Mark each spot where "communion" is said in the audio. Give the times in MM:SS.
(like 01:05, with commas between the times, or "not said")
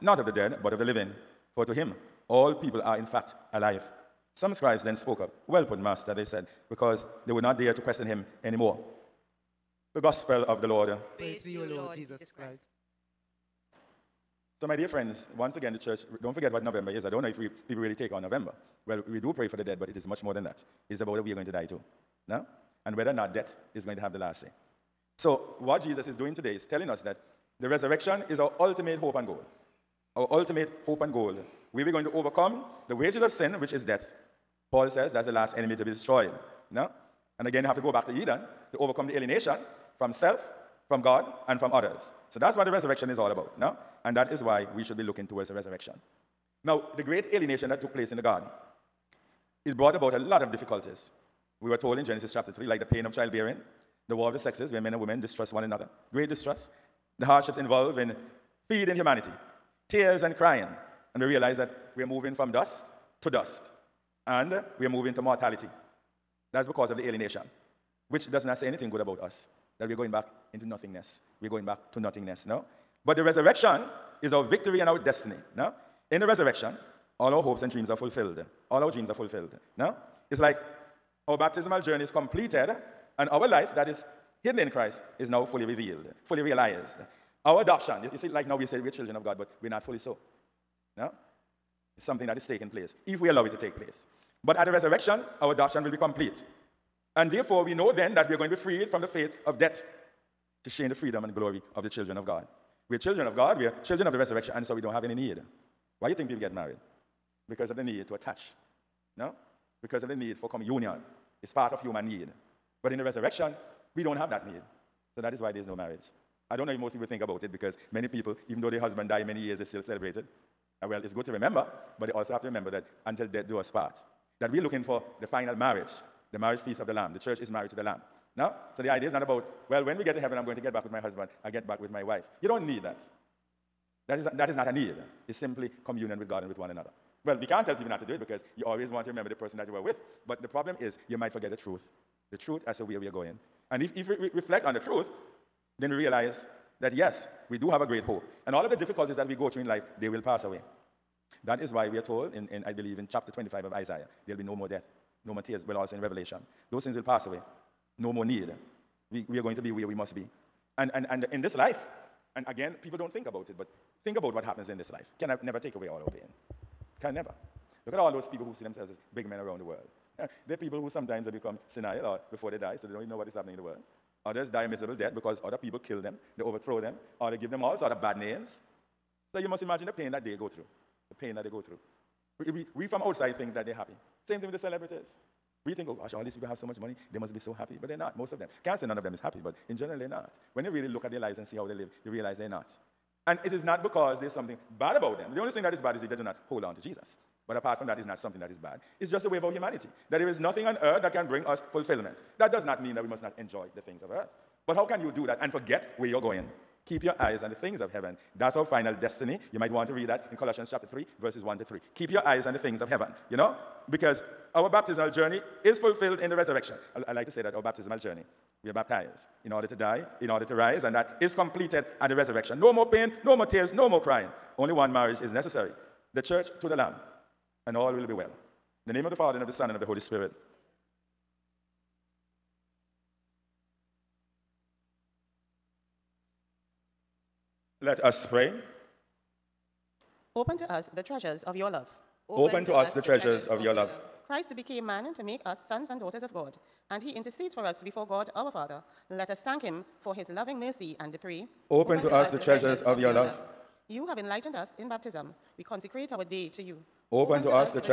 01:50, 02:15.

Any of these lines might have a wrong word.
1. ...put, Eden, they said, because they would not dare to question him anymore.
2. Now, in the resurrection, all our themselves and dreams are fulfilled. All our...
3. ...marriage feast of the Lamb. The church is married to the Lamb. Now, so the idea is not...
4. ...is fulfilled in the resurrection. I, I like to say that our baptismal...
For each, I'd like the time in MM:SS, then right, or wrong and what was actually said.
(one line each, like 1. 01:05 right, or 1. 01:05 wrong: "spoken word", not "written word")
1. 00:05 wrong: "Master", not "Eden"
2. 01:15 wrong: "hopes", not "themselves"
3. 02:06 right
4. 03:35 right.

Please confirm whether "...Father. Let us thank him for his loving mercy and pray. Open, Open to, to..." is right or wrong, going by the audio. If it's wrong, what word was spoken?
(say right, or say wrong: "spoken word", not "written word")
right.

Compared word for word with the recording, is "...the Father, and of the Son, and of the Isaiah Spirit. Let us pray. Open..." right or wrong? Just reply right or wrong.
wrong.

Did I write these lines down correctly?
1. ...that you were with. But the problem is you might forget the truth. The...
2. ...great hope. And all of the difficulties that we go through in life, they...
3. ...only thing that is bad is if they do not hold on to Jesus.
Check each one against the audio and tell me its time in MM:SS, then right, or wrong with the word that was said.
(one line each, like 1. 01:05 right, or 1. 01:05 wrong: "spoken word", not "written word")
1. 02:19 right
2. 02:27 right
3. 03:15 right.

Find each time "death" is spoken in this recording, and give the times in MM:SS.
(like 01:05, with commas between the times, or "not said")
00:23, 00:33, 01:39, 02:03, 02:34, 02:54.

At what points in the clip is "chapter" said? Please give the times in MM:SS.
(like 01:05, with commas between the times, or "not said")
00:52, 02:33, 03:30.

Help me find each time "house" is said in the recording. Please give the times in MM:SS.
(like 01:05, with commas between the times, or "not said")
not said.